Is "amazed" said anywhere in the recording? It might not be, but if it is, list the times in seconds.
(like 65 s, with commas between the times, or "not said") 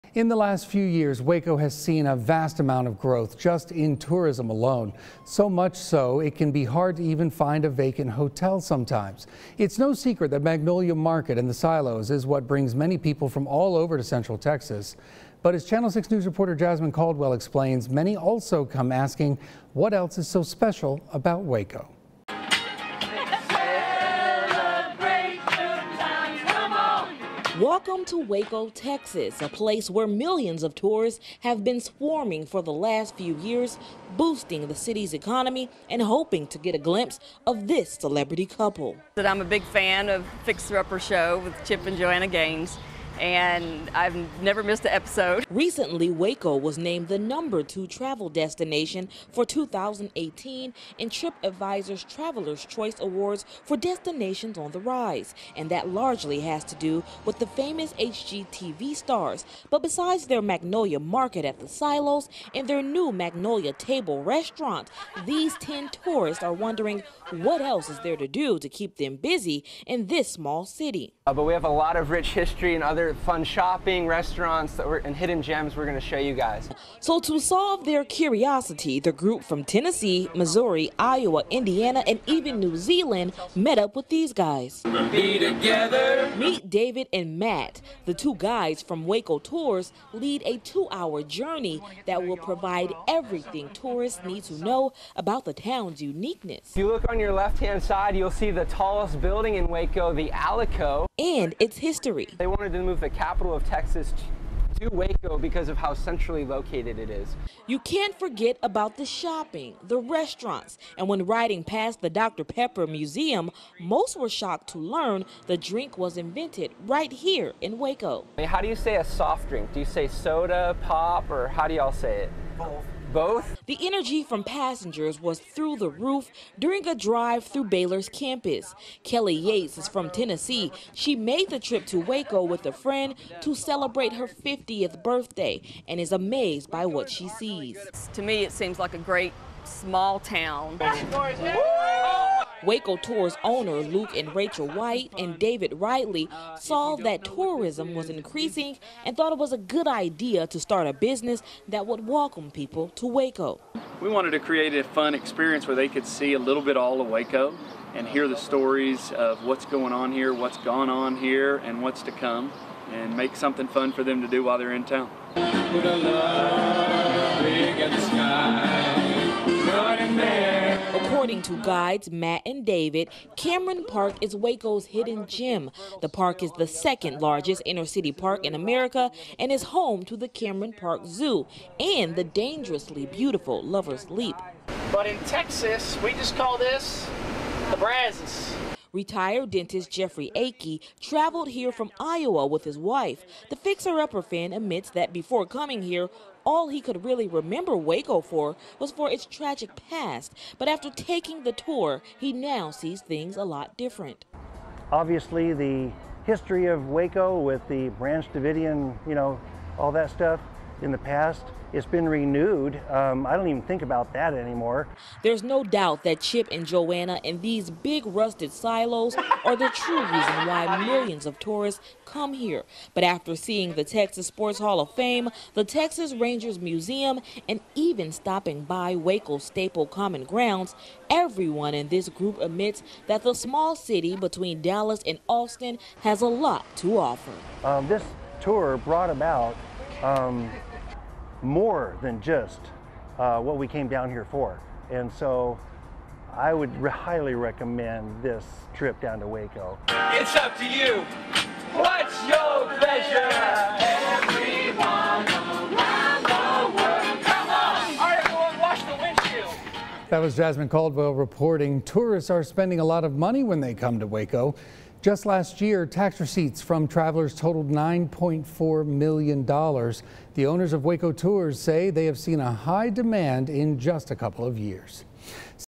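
136 s.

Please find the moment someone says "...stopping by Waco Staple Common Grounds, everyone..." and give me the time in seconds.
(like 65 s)
228 s.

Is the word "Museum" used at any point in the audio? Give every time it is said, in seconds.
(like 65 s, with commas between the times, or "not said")
112 s, 226 s.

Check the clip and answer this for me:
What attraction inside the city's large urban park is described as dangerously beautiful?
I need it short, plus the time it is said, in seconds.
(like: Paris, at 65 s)
Lover's Leap, at 183 s.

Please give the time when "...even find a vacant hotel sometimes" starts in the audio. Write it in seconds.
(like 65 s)
7 s.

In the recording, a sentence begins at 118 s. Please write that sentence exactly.
I mean, how do you say a soft drink?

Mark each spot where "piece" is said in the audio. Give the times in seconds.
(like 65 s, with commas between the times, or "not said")
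not said.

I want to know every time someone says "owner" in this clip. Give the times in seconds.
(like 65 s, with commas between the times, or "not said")
143 s, 270 s.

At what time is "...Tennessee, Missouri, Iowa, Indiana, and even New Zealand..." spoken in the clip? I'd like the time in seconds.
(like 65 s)
79 s.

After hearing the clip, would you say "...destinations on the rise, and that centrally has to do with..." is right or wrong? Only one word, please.
wrong.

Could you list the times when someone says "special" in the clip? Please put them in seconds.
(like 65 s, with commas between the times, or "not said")
20 s.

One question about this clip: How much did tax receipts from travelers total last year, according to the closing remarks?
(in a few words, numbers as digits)
$9.4 million.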